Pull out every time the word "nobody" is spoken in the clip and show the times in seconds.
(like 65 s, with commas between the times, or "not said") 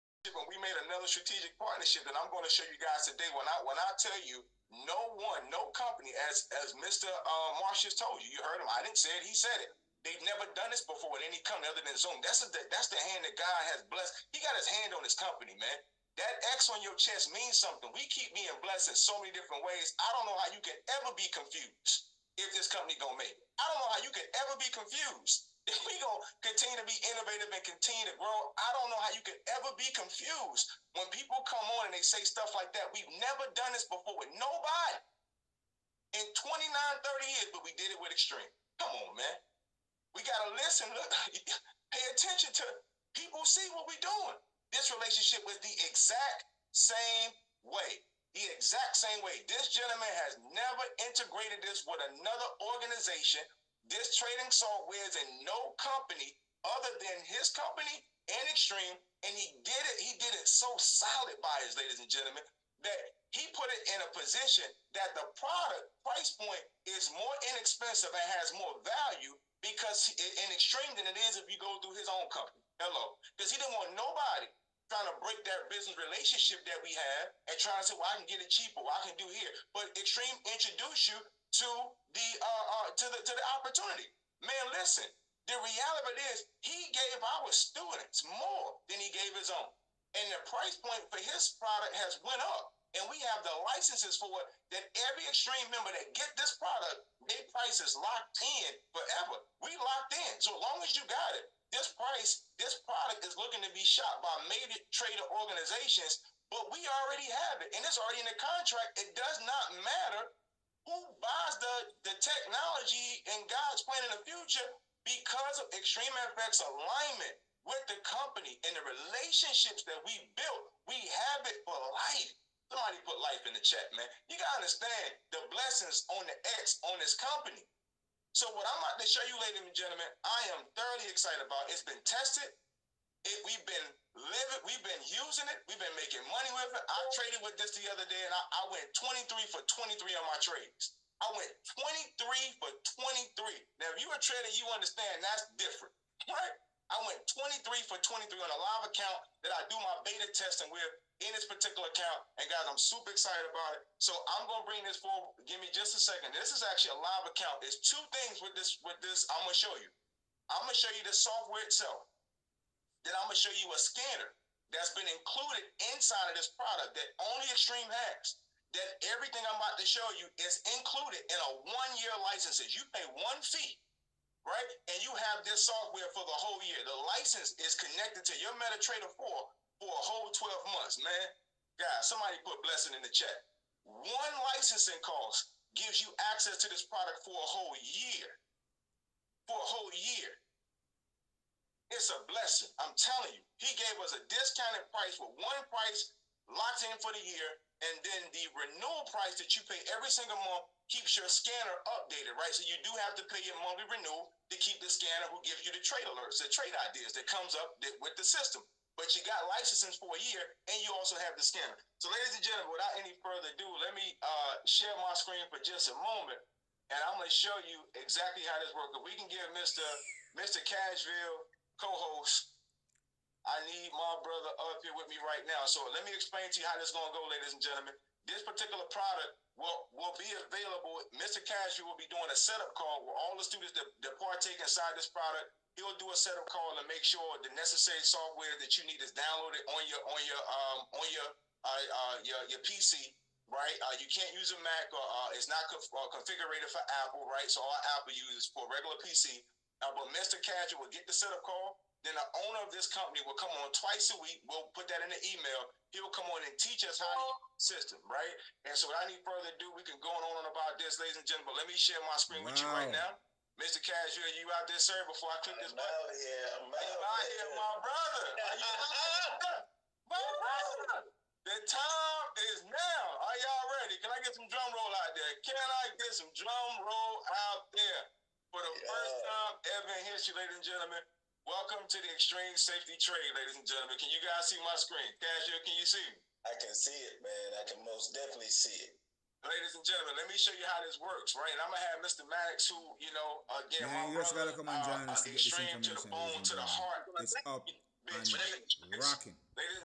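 34 s, 73 s.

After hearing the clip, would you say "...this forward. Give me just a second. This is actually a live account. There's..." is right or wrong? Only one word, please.
right.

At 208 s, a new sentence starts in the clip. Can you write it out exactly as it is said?
But you got licenses for a year, and you also have the scanner.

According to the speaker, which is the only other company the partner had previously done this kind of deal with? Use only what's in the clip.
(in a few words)
Zoom.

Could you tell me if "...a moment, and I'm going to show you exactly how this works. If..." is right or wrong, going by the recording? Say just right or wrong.
right.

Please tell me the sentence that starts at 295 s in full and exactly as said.
To the bone, to the heart.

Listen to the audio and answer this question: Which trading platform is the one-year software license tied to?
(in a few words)
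MetaTrader 4.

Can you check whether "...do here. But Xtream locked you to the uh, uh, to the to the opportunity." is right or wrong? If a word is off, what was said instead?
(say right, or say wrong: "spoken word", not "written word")
wrong: "introduced", not "locked".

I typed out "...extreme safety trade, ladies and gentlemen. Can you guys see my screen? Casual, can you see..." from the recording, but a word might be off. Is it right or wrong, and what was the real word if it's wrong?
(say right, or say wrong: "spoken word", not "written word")
right.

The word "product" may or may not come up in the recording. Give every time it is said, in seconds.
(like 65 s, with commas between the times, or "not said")
65 s, 91 s, 96 s, 102 s, 166 s, 186 s, 228 s, 235 s.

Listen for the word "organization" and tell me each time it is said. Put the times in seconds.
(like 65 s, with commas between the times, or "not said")
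52 s, 105 s.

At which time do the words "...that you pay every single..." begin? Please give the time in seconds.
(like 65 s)
199 s.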